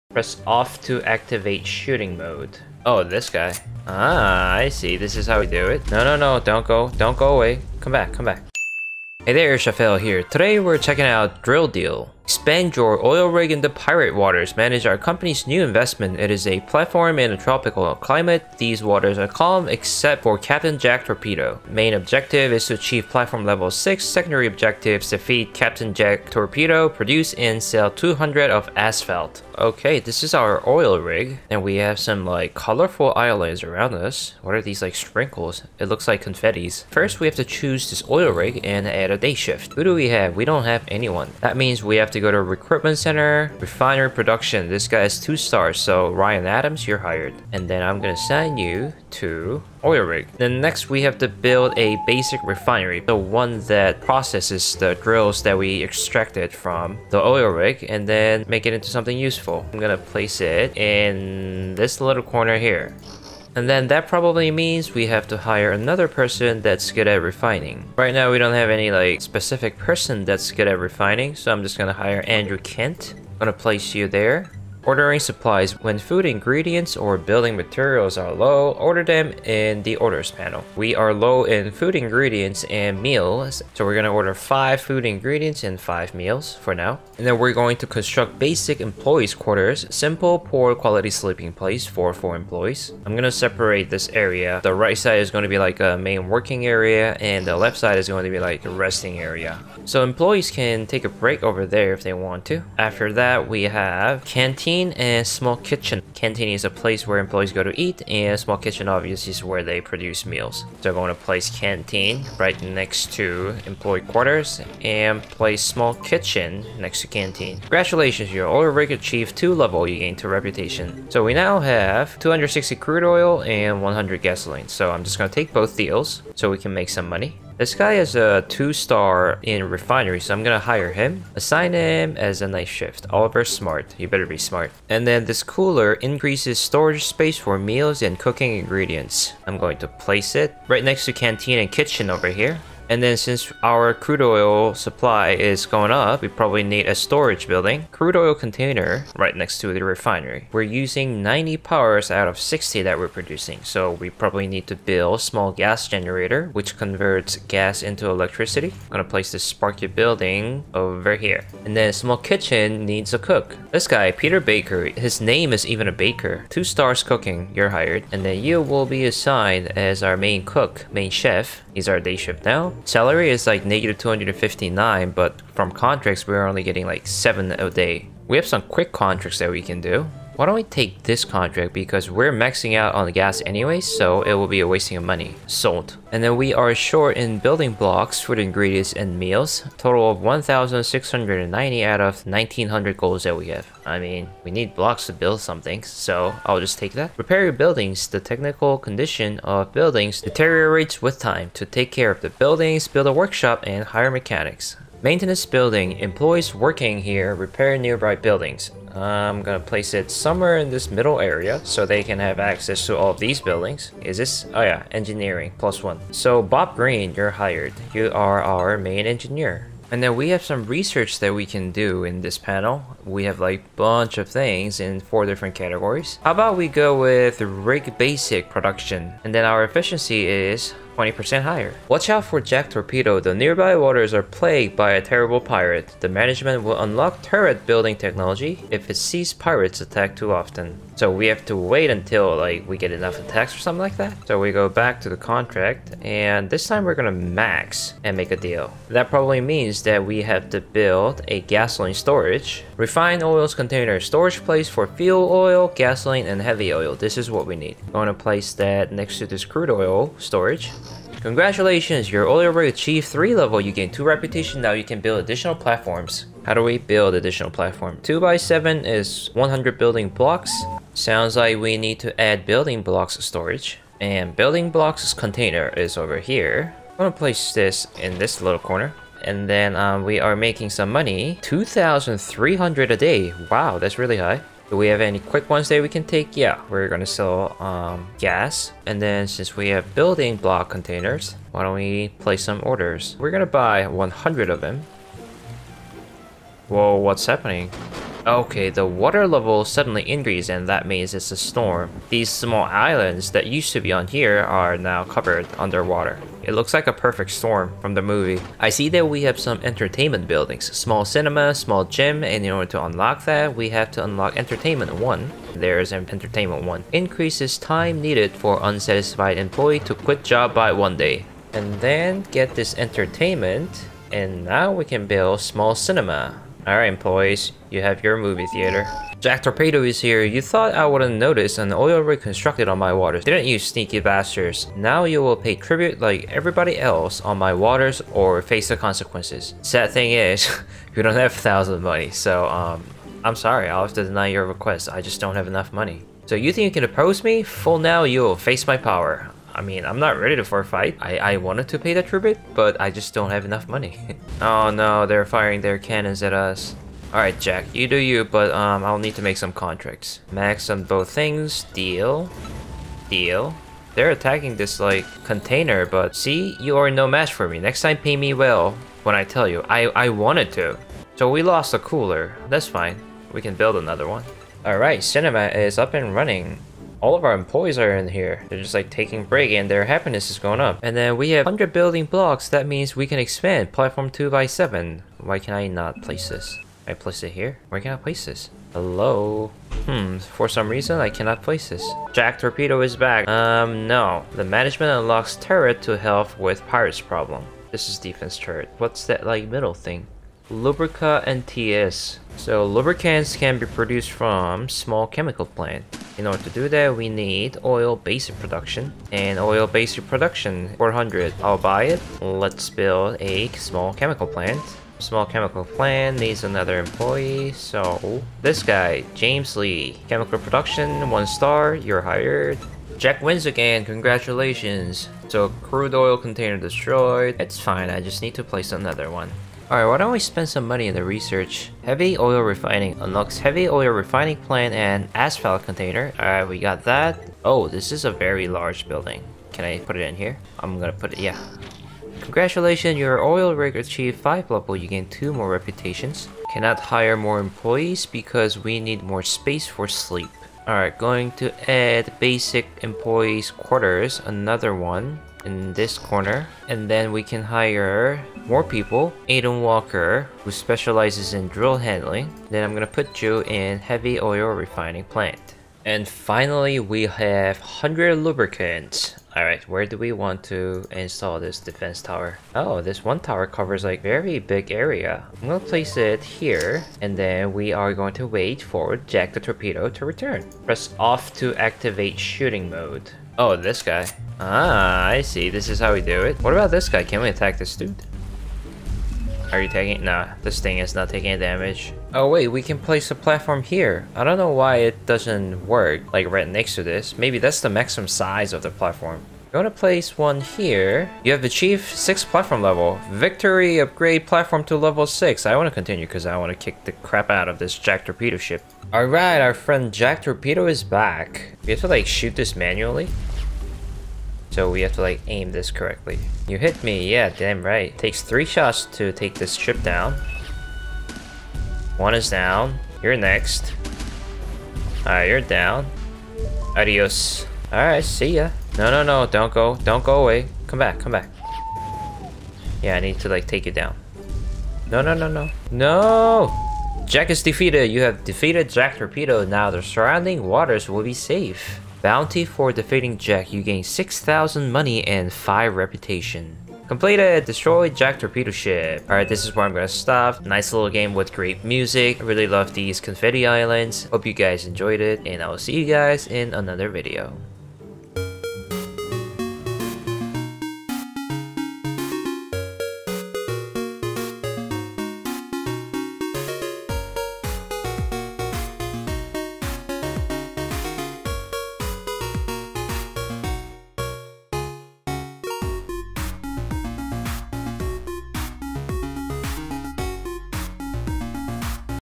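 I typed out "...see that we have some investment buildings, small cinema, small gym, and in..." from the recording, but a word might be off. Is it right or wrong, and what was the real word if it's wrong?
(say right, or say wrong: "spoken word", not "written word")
wrong: "entertainment", not "investment".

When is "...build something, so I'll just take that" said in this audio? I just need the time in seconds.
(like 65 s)
195 s.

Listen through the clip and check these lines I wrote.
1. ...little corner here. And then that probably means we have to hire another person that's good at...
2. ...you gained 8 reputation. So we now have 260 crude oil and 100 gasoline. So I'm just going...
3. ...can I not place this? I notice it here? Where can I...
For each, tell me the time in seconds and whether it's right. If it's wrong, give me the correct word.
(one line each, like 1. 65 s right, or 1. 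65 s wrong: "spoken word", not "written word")
1. 61 s right
2. 119 s wrong: "2", not "8"
3. 385 s wrong: "place", not "notice".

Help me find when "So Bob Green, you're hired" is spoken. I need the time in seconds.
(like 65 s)
216 s.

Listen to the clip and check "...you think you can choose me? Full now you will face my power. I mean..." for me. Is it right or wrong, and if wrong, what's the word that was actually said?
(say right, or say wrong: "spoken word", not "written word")
wrong: "oppose", not "choose".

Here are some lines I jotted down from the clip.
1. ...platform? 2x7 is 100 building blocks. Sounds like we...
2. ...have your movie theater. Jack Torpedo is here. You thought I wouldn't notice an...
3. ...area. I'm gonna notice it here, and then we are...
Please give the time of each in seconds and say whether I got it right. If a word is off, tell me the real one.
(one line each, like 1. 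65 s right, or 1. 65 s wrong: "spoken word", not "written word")
1. 267 s right
2. 327 s right
3. 474 s wrong: "place", not "notice".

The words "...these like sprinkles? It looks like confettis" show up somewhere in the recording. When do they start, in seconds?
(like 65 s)
34 s.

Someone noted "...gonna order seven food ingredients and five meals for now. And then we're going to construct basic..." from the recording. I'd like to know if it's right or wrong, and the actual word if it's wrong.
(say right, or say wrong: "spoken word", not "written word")
wrong: "five", not "seven".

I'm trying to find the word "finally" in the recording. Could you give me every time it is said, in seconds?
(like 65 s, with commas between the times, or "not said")
466 s.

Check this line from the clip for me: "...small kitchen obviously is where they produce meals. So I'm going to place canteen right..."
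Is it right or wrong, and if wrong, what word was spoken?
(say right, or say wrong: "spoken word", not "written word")
right.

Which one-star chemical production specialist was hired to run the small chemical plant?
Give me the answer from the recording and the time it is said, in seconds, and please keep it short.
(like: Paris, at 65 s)
James Lee, at 419 s.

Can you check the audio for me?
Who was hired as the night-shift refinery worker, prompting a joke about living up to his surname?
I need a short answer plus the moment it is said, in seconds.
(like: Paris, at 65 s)
Oliver Smart, at 133 s.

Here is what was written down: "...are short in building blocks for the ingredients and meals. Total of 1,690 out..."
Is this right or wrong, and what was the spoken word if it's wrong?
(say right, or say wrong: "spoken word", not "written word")
right.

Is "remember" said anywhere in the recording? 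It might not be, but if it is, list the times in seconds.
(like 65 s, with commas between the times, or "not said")
not said.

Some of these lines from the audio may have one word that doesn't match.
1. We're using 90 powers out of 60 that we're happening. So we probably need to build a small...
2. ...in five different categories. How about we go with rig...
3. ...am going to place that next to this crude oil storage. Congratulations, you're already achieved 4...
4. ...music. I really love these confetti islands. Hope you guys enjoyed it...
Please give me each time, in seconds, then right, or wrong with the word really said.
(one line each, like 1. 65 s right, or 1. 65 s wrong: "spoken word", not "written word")
1. 150 s wrong: "producing", not "happening"
2. 224 s wrong: "four", not "five"
3. 257 s wrong: "3", not "4"
4. 551 s right.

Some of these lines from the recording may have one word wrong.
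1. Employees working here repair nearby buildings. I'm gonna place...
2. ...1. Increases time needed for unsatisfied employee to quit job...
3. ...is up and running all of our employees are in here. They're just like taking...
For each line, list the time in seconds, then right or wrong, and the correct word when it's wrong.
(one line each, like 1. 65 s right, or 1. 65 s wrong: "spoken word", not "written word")
1. 205 s right
2. 316 s right
3. 375 s right.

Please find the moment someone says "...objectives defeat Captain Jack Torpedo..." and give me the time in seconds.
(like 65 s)
24 s.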